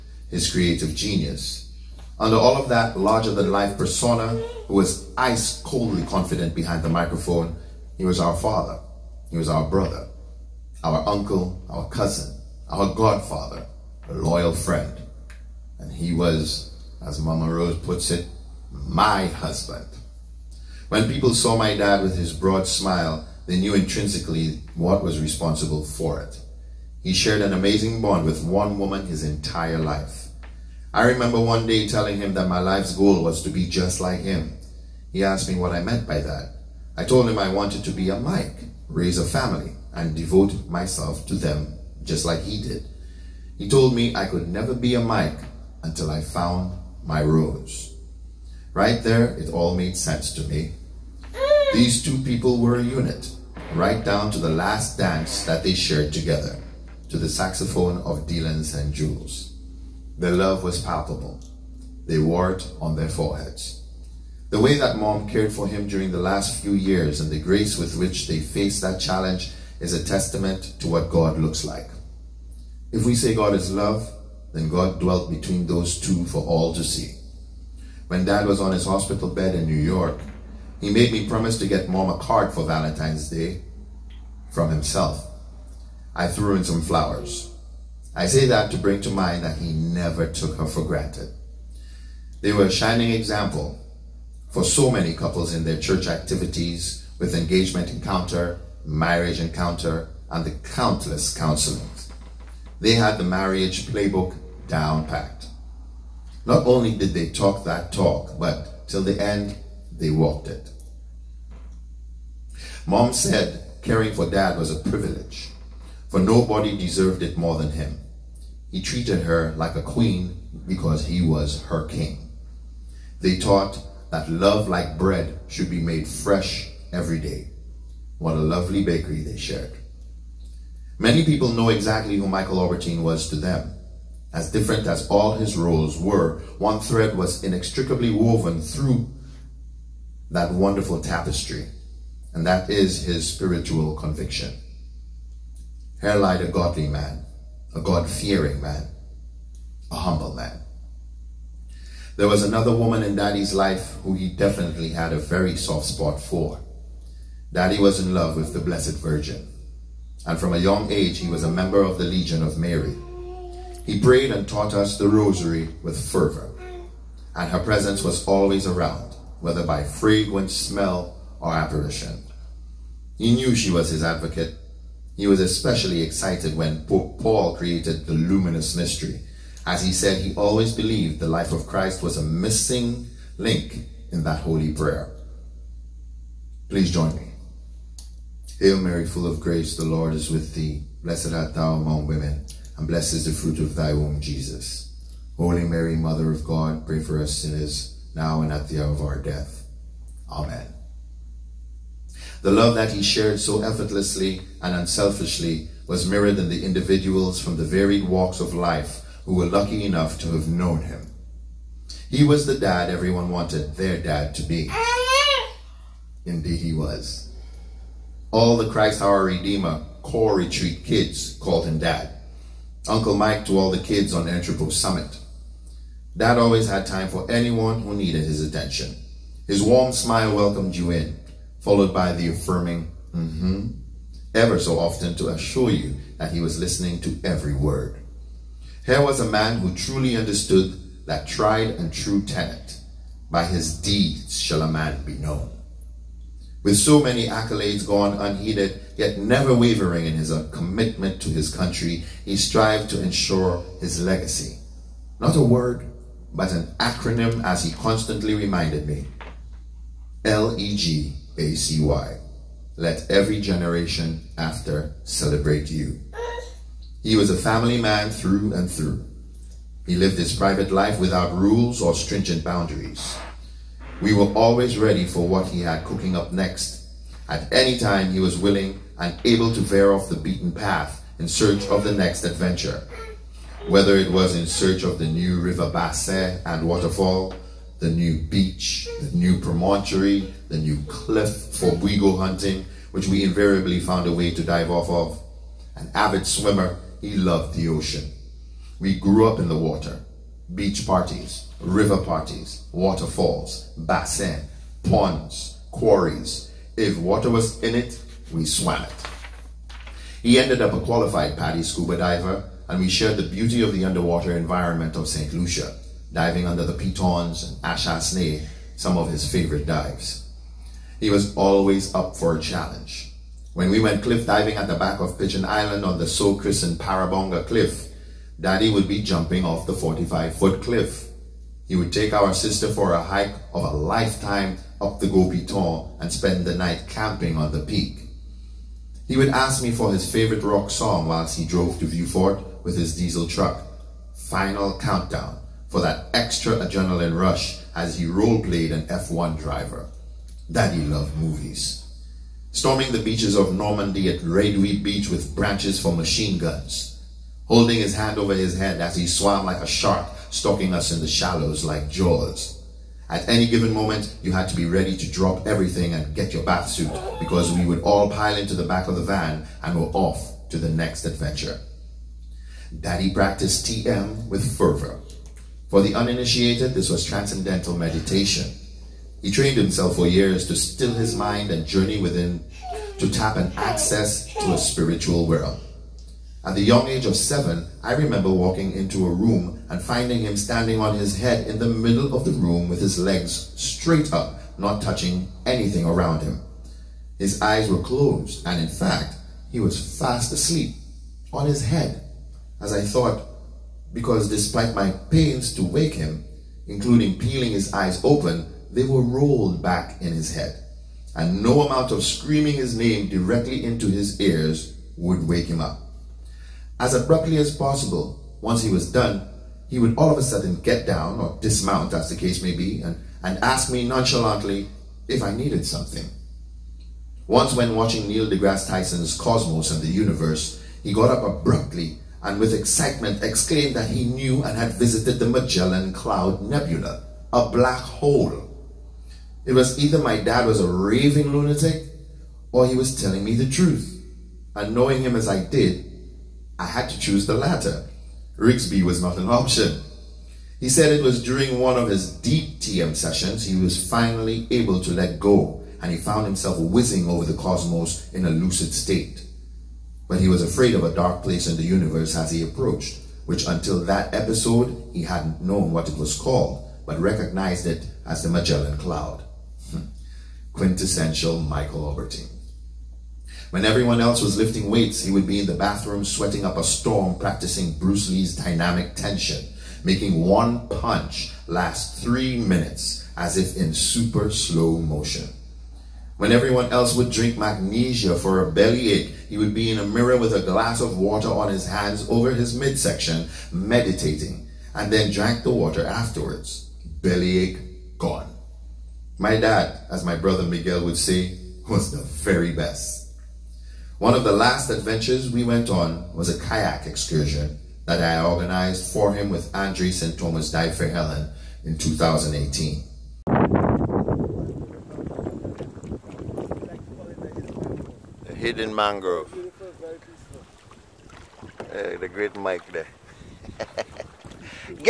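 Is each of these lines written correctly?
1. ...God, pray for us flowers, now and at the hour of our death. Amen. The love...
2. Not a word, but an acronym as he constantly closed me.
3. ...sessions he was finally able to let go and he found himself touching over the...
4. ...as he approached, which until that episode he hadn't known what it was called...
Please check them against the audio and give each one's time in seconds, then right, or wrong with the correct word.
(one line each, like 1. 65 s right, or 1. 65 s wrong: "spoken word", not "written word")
1. 196 s wrong: "sinners", not "flowers"
2. 255 s wrong: "reminded", not "closed"
3. 452 s wrong: "whizzing", not "touching"
4. 462 s right.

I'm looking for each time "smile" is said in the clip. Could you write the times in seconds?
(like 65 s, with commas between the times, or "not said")
22 s, 229 s.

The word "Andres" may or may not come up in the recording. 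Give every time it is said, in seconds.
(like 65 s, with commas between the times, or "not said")
509 s.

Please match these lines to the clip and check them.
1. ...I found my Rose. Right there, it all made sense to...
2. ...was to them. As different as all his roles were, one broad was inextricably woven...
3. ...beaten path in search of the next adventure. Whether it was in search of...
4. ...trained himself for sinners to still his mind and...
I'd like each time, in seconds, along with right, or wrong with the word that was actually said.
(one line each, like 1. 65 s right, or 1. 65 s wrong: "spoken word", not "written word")
1. 46 s right
2. 133 s wrong: "thread", not "broad"
3. 280 s right
4. 379 s wrong: "years", not "sinners".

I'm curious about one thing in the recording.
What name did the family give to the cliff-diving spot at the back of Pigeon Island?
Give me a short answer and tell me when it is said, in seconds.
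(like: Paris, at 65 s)
Parabonga Cliff, at 326 s.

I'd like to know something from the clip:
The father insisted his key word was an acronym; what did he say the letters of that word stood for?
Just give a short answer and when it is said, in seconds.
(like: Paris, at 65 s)
Let every generation after celebrate you, at 262 s.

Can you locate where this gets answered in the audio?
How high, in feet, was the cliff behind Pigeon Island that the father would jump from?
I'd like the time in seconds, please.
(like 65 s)
329 s.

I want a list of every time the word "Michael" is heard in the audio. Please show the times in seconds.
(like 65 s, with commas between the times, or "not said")
132 s, 471 s.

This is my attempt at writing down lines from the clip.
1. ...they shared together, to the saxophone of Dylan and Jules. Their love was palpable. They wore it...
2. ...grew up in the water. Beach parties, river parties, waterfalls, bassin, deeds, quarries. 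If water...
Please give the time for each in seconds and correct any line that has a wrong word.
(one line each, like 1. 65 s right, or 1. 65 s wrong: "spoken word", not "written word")
1. 55 s right
2. 298 s wrong: "ponds", not "deeds".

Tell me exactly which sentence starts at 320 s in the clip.
He was always up for a challenge.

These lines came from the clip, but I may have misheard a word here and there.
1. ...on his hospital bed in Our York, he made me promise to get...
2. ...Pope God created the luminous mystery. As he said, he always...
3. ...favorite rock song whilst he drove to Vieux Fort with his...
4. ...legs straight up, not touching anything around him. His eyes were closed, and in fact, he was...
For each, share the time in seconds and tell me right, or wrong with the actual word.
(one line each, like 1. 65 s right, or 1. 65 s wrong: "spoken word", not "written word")
1. 78 s wrong: "New", not "Our"
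2. 176 s wrong: "Paul", not "God"
3. 340 s right
4. 392 s right.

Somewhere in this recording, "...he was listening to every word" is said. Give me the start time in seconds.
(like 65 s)
236 s.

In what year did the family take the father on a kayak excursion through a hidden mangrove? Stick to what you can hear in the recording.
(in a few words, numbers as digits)
2018.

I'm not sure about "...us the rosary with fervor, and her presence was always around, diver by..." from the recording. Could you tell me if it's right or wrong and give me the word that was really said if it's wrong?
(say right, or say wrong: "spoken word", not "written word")
wrong: "whether", not "diver".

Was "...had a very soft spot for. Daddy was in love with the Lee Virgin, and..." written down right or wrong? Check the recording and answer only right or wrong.
wrong.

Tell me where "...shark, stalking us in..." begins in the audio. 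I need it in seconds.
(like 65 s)
359 s.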